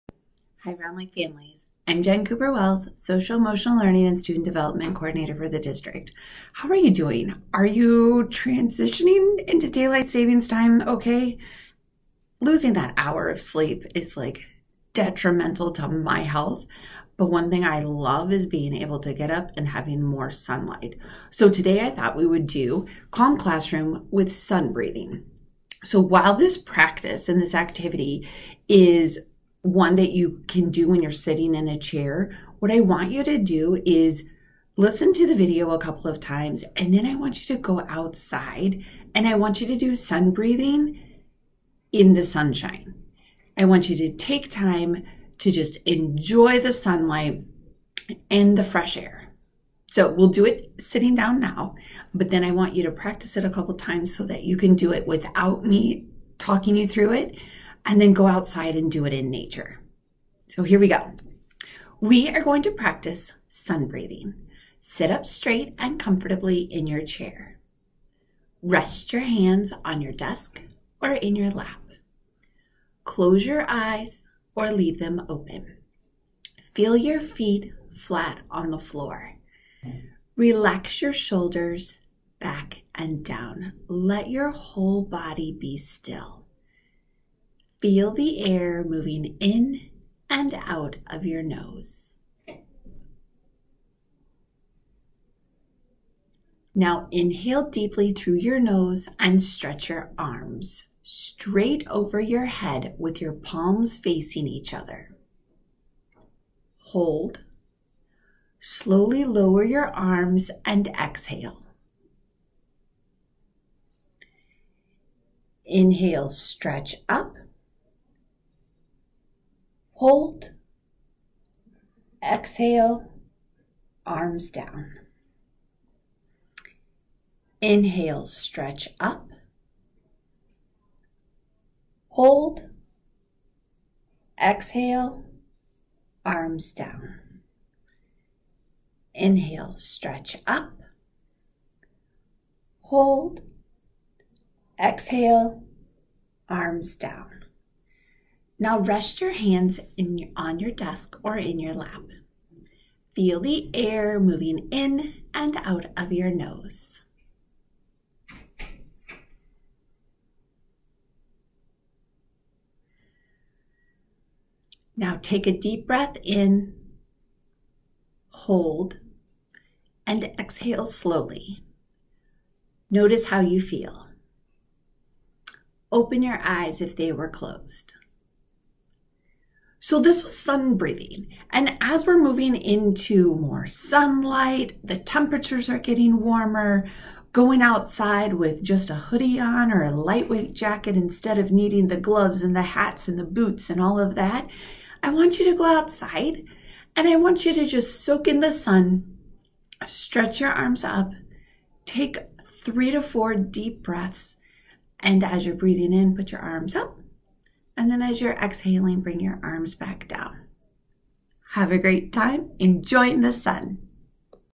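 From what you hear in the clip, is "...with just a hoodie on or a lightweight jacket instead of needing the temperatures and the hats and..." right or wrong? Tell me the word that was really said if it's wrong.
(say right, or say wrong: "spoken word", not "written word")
wrong: "gloves", not "temperatures".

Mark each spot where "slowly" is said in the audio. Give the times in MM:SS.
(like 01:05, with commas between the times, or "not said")
01:48, 02:50.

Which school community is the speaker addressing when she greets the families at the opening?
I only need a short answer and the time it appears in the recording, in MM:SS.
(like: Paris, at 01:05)
Round Lake, at 00:00.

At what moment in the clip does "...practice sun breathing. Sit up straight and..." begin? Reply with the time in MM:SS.
01:02.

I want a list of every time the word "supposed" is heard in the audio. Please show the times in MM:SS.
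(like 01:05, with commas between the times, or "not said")
not said.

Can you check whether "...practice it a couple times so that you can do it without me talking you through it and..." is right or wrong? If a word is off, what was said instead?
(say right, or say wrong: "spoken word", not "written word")
right.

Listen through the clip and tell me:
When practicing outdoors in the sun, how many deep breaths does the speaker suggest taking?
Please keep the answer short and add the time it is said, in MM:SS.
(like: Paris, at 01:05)
3 to 4, at 03:22.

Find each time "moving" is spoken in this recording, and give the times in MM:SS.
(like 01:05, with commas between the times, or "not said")
01:28, 02:34, 03:02.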